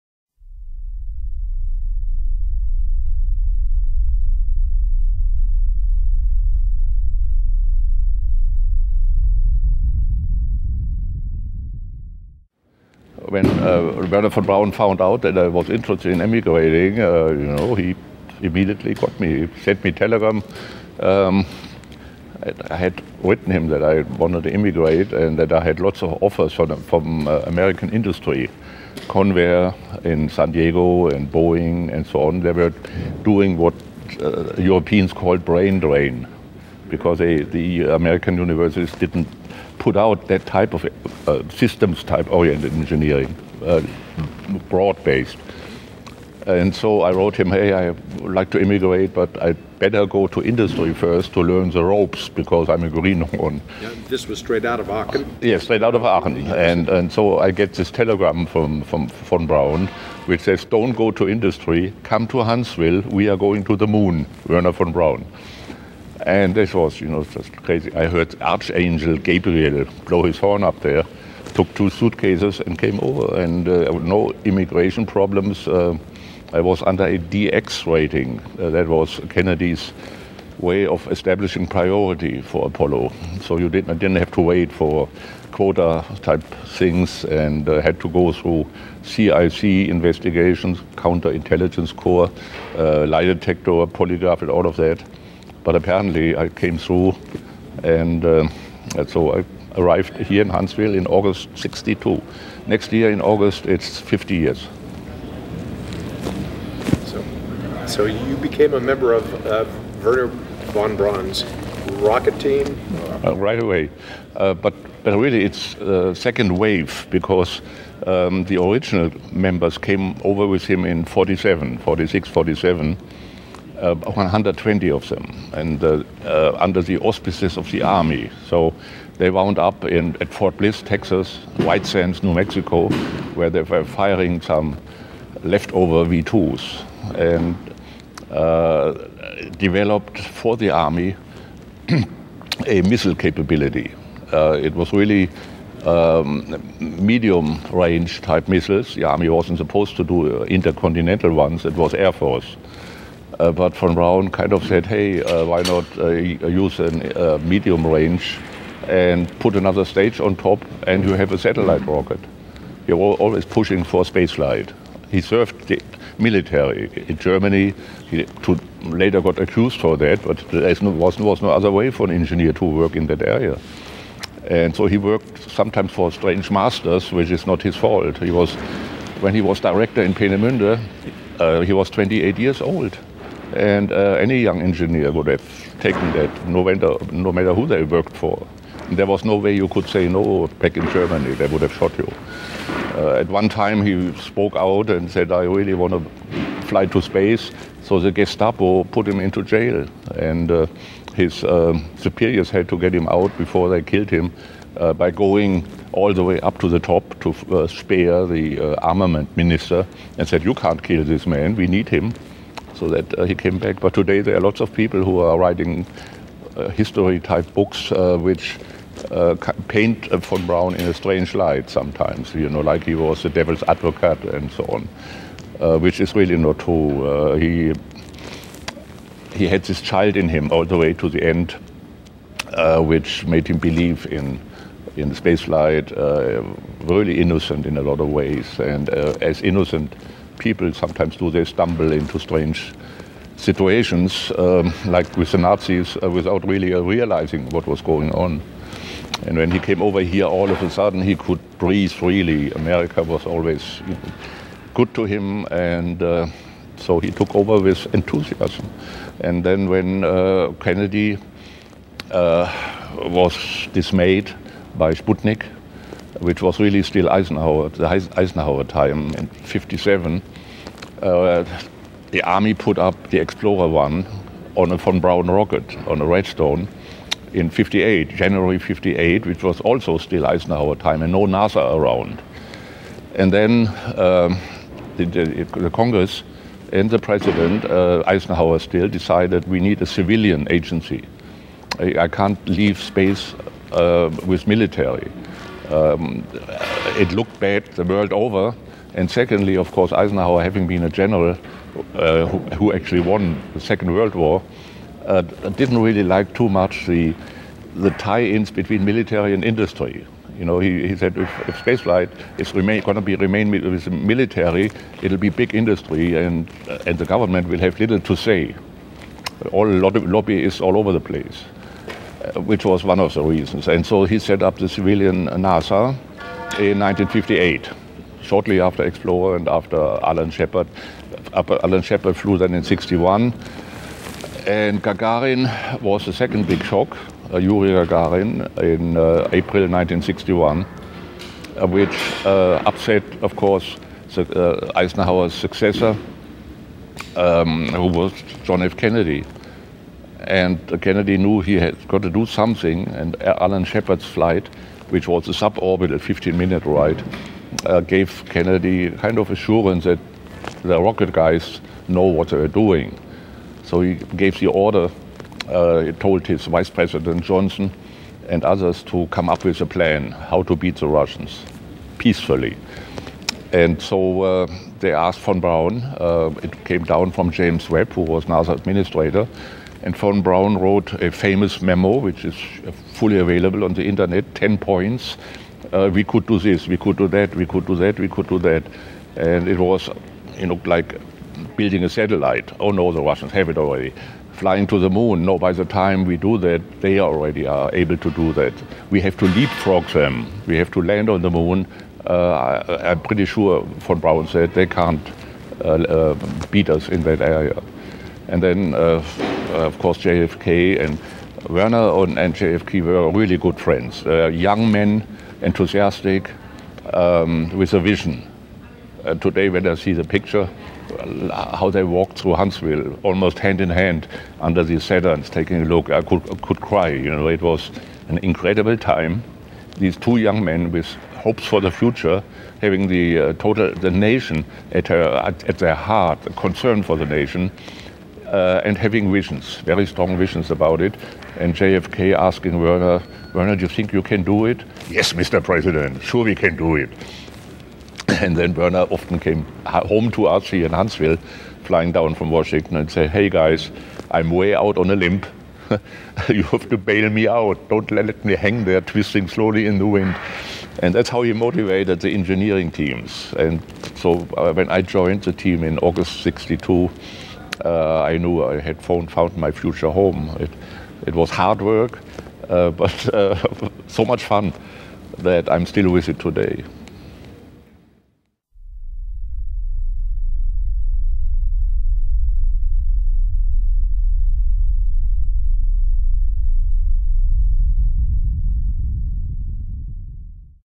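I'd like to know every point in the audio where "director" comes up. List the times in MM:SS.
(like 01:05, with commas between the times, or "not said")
02:59.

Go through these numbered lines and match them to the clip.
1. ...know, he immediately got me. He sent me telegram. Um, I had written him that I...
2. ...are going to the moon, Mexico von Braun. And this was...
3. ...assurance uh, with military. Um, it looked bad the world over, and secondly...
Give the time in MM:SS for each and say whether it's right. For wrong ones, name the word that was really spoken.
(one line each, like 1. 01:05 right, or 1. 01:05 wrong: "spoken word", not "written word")
1. 00:17 right
2. 01:03 wrong: "Werner", not "Mexico"
3. 04:52 wrong: "space", not "assurance".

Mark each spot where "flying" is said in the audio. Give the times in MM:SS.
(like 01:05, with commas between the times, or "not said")
06:34, 07:31.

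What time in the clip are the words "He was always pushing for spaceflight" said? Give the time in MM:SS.
02:42.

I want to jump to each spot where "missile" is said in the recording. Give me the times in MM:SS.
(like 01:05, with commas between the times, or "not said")
02:22, 02:28.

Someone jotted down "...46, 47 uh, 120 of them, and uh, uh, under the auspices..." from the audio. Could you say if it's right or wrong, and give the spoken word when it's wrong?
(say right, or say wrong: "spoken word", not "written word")
right.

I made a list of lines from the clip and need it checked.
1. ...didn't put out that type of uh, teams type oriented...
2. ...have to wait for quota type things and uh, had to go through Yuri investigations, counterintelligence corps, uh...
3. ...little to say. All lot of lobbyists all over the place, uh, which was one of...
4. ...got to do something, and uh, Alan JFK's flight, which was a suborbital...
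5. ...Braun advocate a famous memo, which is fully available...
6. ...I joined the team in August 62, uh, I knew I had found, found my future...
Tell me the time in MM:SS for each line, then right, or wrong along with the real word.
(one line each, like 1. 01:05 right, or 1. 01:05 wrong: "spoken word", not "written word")
1. 00:38 wrong: "systems", not "teams"
2. 01:24 wrong: "CIC", not "Yuri"
3. 05:17 right
4. 05:51 wrong: "Shepard", not "JFK"
5. 06:20 wrong: "wrote", not "advocate"
6. 07:44 right.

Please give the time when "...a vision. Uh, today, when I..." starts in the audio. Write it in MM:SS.
06:57.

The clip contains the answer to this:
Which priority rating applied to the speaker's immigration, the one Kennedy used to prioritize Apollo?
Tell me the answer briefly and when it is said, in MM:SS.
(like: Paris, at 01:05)
DX rating, at 01:17.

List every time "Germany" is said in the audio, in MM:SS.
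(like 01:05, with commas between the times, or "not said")
02:47, 03:10.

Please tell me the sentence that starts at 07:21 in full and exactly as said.
And JFK asking Werner, Werner, do you think you can do it?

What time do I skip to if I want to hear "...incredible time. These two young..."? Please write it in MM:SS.
07:08.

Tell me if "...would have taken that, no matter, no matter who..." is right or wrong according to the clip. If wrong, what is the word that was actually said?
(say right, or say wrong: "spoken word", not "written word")
right.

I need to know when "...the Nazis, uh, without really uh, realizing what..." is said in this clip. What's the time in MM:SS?
04:05.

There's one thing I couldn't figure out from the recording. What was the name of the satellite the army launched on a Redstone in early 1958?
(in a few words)
Explorer one.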